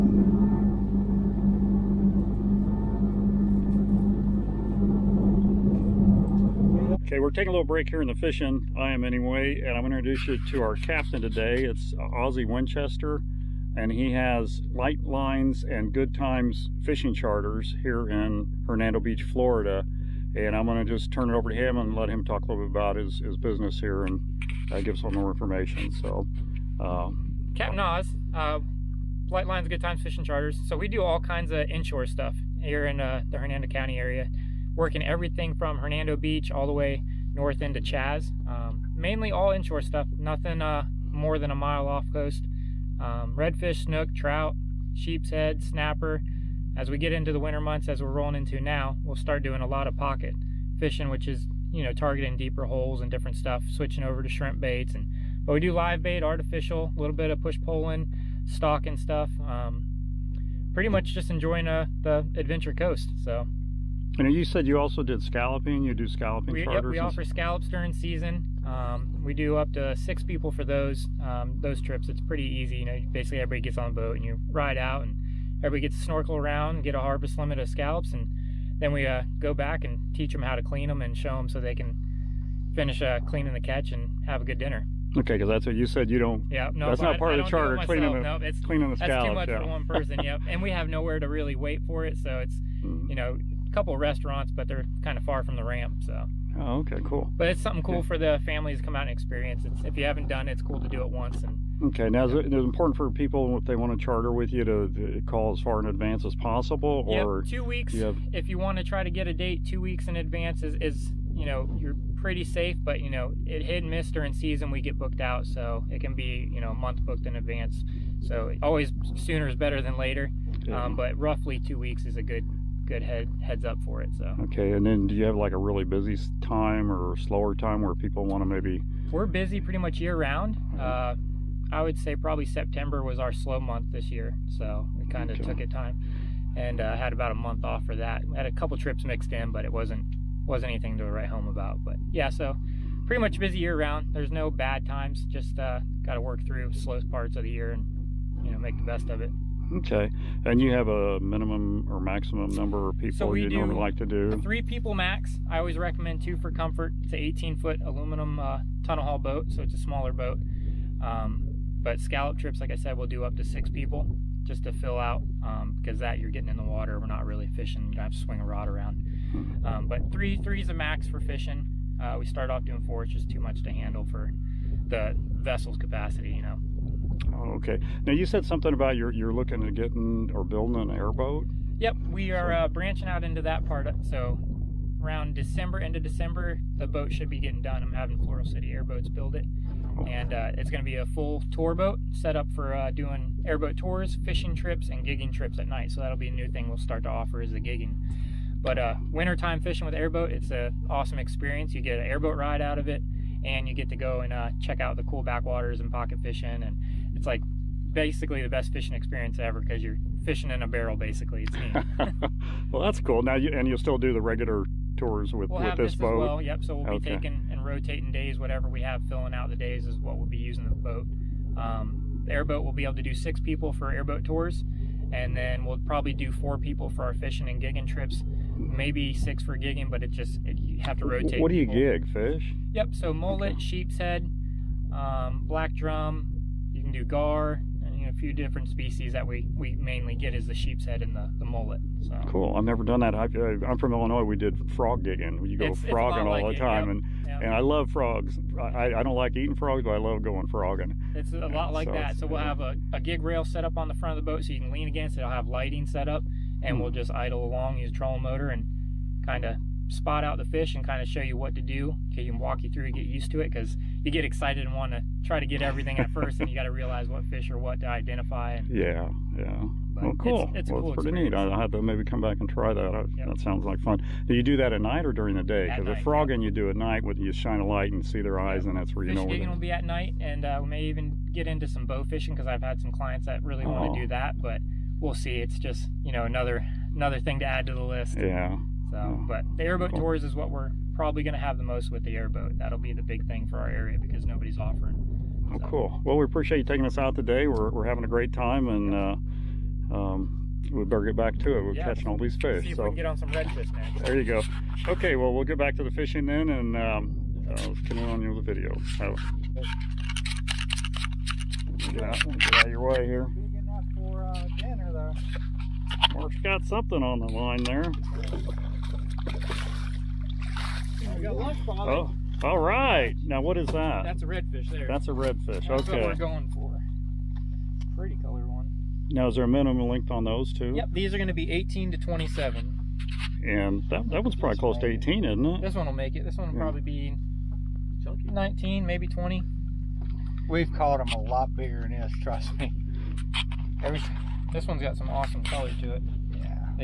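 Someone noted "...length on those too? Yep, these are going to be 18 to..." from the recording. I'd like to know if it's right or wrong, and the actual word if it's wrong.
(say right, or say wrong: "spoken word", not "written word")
right.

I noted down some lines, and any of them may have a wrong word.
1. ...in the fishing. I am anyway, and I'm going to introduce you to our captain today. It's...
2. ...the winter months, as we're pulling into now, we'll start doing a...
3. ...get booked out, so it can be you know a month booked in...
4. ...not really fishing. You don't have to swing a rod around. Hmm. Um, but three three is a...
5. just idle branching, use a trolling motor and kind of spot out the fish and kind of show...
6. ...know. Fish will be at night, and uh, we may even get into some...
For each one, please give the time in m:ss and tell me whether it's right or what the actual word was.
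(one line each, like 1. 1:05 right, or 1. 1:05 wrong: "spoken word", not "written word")
1. 0:08 right
2. 0:47 wrong: "rolling", not "pulling"
3. 1:54 right
4. 2:47 right
5. 4:16 wrong: "along", not "branching"
6. 4:39 right.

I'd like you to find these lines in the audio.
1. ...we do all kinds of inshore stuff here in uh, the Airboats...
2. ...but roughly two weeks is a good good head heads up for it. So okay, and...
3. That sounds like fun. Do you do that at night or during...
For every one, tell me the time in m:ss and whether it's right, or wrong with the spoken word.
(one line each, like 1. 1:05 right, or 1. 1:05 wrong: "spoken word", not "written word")
1. 0:30 wrong: "Hernando", not "Airboats"
2. 2:00 right
3. 4:33 right.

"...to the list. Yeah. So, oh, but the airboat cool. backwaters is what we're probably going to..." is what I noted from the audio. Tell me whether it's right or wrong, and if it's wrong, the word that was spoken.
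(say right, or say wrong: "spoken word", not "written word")
wrong: "tours", not "backwaters".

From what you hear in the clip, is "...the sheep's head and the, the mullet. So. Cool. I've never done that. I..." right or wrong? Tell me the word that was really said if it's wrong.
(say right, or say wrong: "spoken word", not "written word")
right.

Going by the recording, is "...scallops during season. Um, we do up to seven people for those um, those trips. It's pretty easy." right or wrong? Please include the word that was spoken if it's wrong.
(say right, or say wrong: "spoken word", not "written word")
wrong: "six", not "seven".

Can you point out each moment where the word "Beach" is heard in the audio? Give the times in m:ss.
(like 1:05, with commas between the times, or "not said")
0:18, 0:36.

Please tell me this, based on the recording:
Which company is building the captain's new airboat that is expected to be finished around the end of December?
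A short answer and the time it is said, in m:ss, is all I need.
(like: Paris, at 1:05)
Floral City Airboats, at 3:08.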